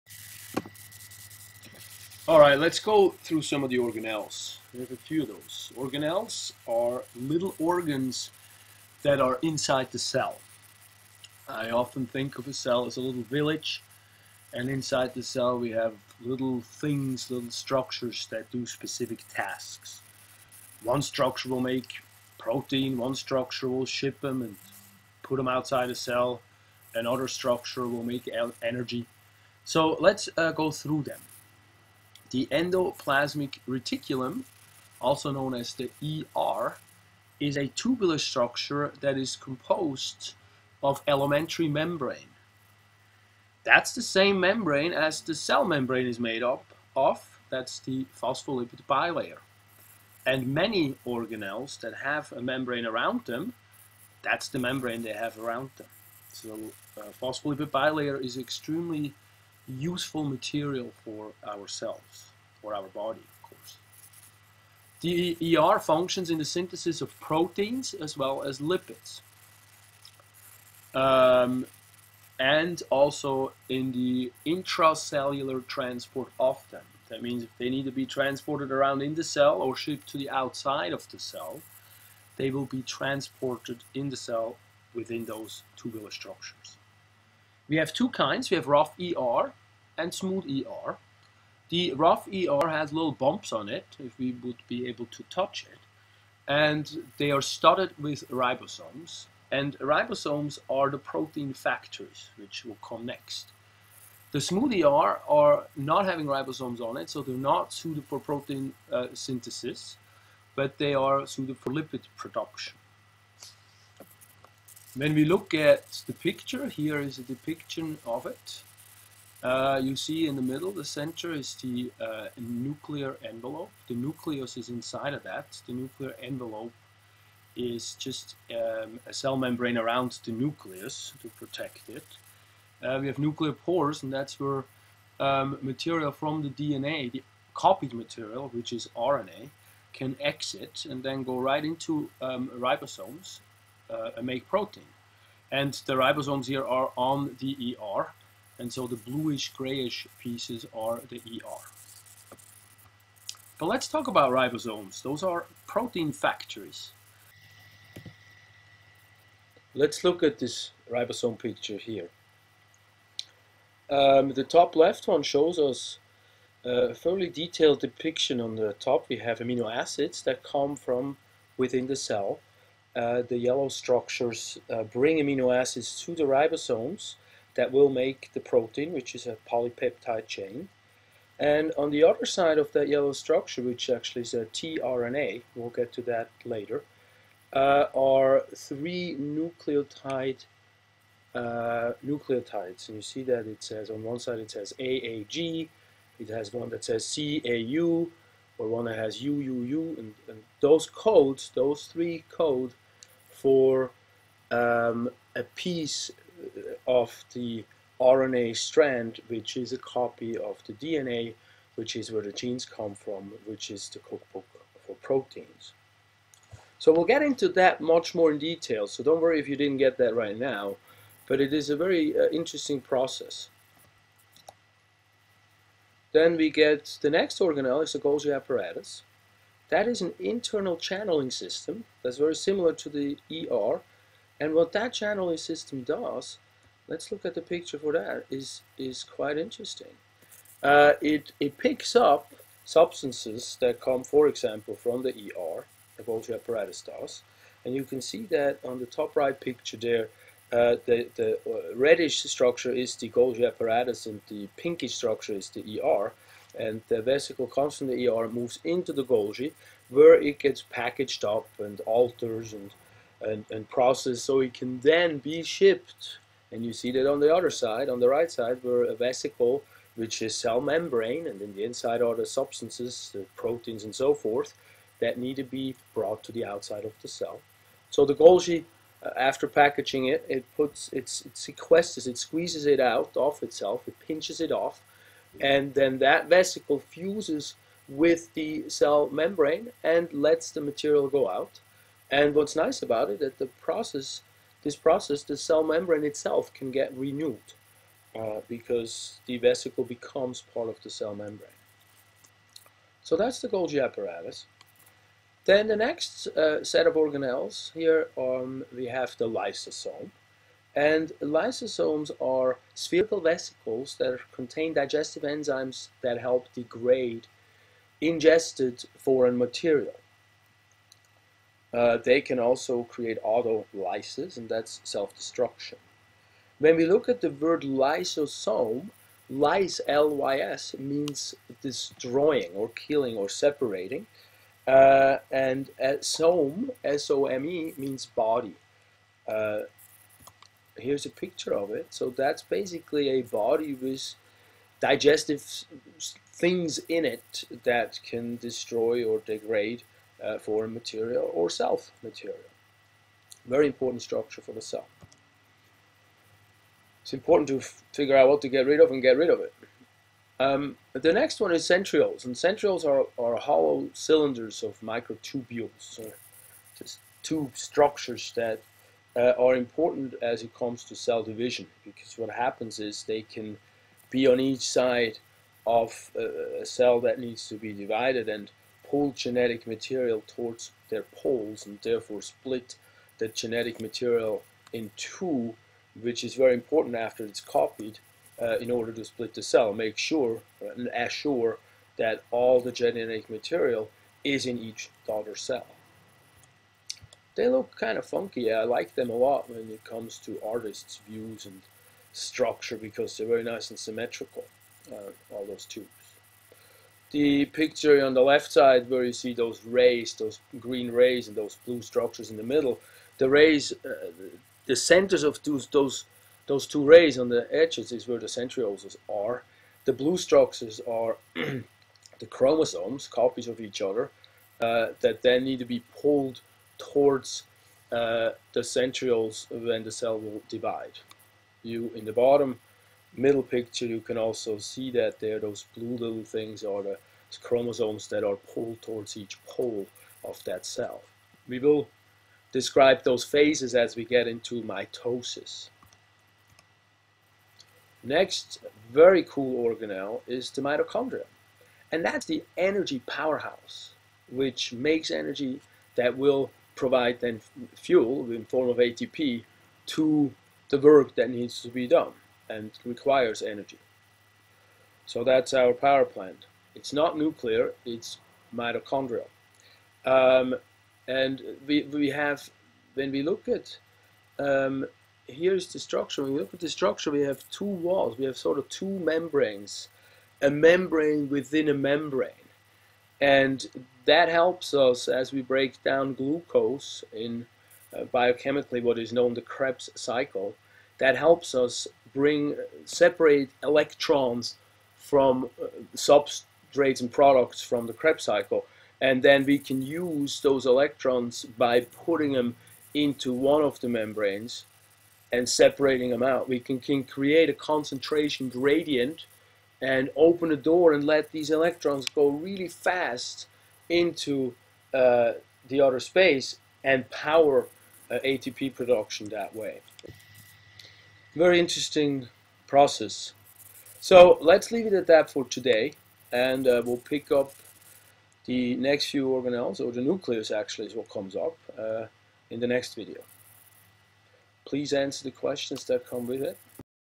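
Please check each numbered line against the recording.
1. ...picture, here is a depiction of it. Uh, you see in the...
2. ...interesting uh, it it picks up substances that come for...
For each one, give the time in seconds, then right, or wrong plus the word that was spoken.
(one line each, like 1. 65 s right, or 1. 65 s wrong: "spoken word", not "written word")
1. 116 s right
2. 239 s right.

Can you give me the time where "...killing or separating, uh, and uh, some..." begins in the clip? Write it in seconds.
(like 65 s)
332 s.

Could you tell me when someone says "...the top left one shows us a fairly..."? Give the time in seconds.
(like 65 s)
164 s.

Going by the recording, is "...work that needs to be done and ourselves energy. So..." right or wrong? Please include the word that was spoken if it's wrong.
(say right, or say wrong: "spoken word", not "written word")
wrong: "requires", not "ourselves".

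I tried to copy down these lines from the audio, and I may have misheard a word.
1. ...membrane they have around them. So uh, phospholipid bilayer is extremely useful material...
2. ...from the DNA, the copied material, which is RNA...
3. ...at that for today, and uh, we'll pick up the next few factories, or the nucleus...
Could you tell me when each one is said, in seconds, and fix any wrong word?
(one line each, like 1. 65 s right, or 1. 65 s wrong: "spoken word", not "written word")
1. 54 s right
2. 136 s right
3. 524 s wrong: "organelles", not "factories".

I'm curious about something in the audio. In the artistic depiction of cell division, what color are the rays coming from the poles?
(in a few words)
Green.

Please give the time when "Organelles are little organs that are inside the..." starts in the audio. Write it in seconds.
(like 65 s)
5 s.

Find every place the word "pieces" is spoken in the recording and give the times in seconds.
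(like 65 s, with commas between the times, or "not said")
150 s, 205 s.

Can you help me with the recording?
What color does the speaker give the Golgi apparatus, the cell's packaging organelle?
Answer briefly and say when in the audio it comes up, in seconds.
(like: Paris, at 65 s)
Reddish, at 251 s.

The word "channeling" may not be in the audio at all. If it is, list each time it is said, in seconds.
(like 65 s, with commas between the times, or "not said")
230 s, 234 s.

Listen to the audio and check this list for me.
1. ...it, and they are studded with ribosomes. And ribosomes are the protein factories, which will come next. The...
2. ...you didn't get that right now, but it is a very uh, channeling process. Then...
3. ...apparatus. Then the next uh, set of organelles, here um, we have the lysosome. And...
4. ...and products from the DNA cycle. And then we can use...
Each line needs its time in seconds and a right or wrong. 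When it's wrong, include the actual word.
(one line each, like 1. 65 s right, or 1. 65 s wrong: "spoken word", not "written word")
1. 95 s right
2. 219 s wrong: "interesting", not "channeling"
3. 303 s right
4. 497 s wrong: "Krebs", not "DNA".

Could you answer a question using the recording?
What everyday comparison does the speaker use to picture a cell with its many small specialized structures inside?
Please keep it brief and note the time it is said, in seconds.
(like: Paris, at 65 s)
A little village, at 12 s.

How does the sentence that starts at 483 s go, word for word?
And that helps us as we break down glucose in uh, biochemically what is known the Krebs cycle.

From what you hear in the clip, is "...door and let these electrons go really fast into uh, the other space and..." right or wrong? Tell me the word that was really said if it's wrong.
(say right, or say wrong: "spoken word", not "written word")
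right.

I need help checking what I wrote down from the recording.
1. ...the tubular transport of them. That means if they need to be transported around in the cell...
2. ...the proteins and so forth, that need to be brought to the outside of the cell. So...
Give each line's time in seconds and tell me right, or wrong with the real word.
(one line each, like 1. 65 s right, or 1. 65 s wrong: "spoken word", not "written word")
1. 73 s wrong: "intracellular", not "tubular"
2. 273 s right.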